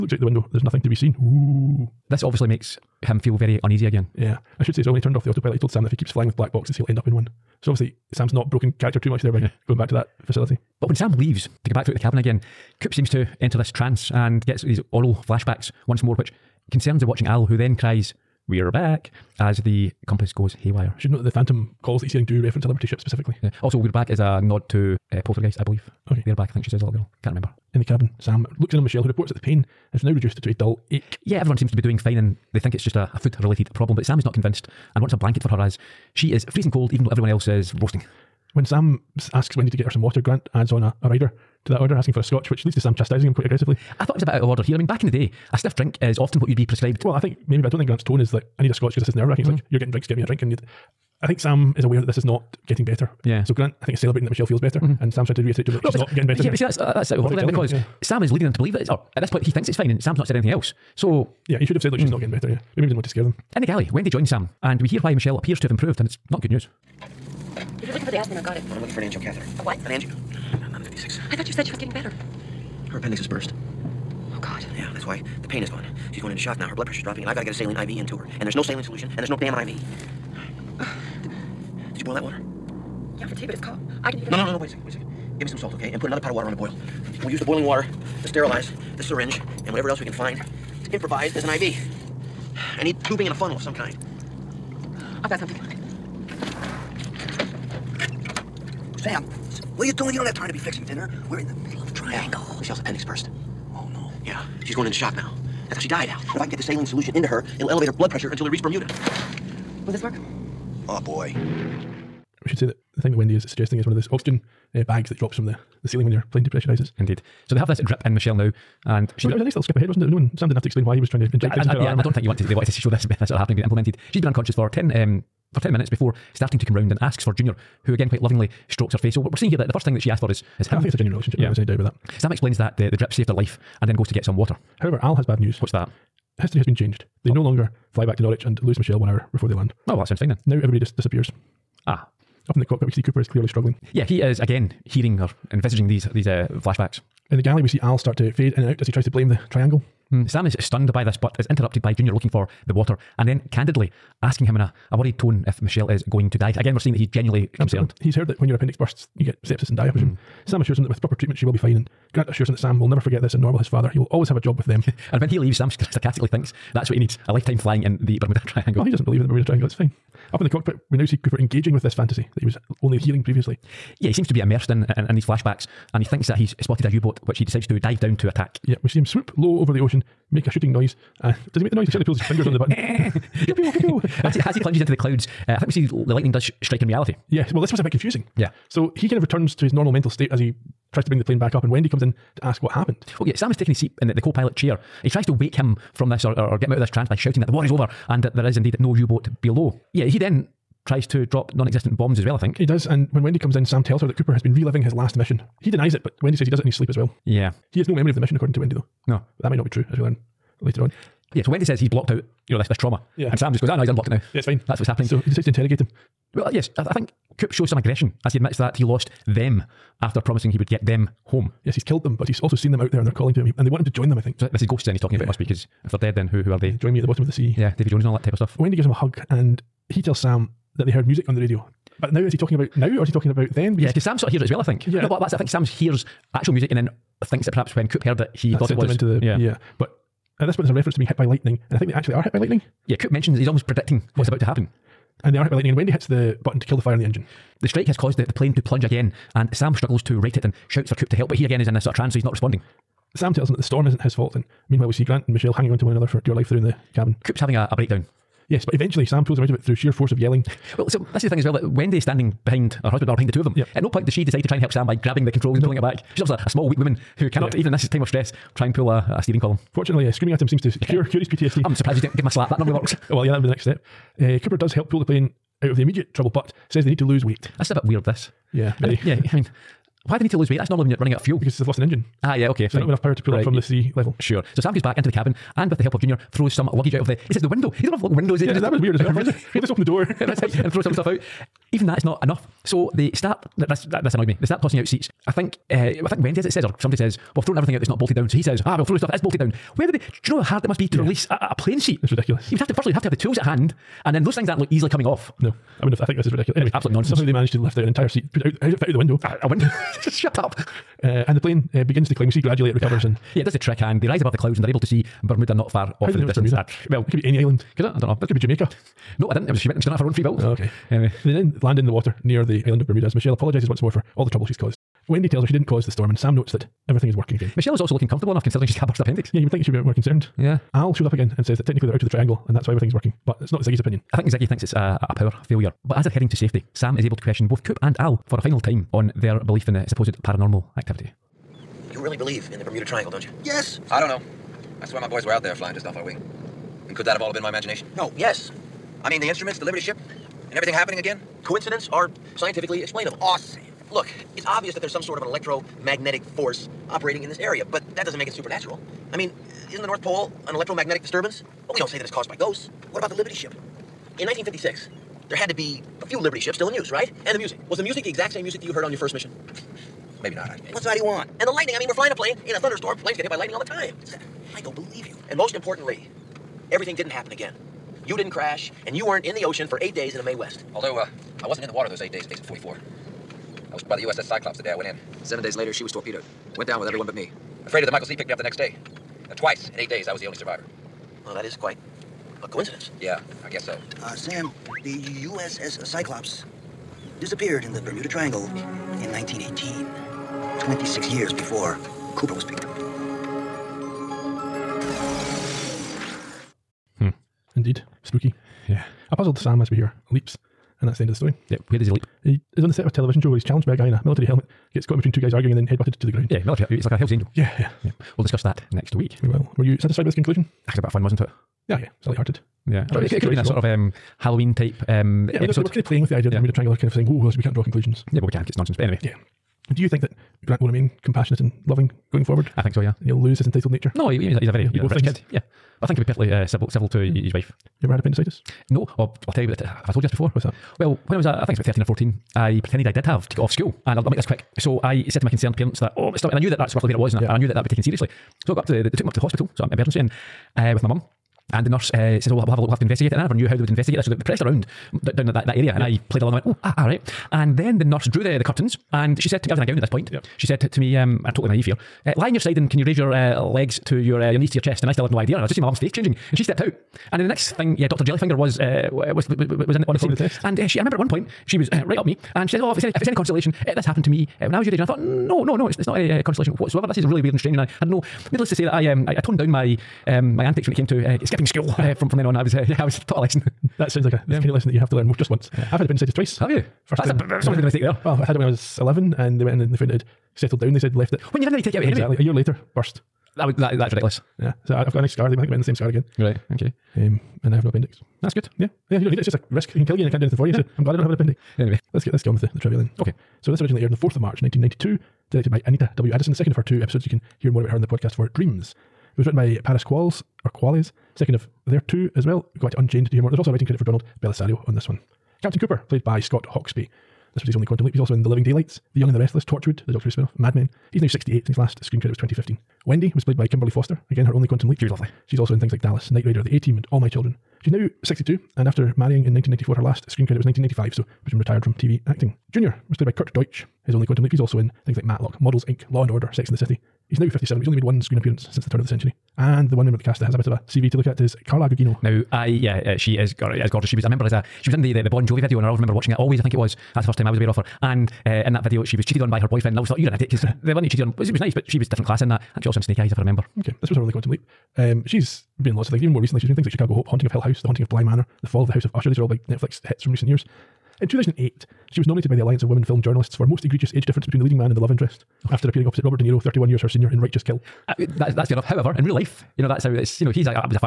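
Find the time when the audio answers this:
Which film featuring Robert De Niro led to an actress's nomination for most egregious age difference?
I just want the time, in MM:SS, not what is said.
09:27.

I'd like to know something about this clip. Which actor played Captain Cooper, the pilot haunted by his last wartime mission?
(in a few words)
Scott Hoxby.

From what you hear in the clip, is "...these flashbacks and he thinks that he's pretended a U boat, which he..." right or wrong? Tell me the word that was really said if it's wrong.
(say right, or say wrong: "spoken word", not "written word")
wrong: "spotted", not "pretended".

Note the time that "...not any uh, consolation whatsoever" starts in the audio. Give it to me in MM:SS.
07:55.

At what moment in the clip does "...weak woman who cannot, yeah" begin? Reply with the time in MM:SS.
04:26.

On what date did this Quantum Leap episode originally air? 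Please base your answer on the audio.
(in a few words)
4 March 1992.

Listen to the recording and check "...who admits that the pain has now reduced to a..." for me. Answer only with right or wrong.
wrong.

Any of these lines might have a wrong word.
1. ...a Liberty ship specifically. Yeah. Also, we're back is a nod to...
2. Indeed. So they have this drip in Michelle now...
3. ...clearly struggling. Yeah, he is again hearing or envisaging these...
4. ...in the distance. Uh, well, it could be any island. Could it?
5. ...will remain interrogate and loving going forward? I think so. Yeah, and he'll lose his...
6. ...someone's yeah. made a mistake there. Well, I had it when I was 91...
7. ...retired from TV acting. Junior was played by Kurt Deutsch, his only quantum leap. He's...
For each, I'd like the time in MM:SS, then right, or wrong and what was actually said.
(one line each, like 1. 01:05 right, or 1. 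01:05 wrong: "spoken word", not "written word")
1. 00:22 right
2. 01:56 right
3. 02:23 right
4. 05:16 right
5. 07:10 wrong: "compassionate", not "interrogate"
6. 08:07 wrong: "11", not "91"
7. 08:51 right.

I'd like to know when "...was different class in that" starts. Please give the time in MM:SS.
09:11.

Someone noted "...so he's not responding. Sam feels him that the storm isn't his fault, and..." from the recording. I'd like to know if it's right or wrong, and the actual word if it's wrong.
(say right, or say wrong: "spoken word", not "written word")
wrong: "tells", not "feels".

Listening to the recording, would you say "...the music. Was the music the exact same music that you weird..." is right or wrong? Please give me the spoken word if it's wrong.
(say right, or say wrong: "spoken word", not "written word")
wrong: "heard", not "weird".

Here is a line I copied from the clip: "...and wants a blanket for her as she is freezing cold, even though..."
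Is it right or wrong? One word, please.
right.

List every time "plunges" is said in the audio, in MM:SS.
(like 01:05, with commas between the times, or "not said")
03:04, 04:08.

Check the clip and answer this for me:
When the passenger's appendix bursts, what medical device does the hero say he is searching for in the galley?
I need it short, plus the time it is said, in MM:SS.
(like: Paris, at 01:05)
Angiocatheter, at 01:09.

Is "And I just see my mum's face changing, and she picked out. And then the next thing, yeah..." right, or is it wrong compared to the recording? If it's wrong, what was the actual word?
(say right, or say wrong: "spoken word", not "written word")
wrong: "stepped", not "picked".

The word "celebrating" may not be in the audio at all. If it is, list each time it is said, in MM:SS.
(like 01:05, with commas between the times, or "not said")
00:53.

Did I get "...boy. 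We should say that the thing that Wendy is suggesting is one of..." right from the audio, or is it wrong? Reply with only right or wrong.
right.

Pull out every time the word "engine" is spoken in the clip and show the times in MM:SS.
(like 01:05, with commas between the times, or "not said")
04:07, 04:41.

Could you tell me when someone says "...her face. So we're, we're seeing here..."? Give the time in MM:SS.
02:08.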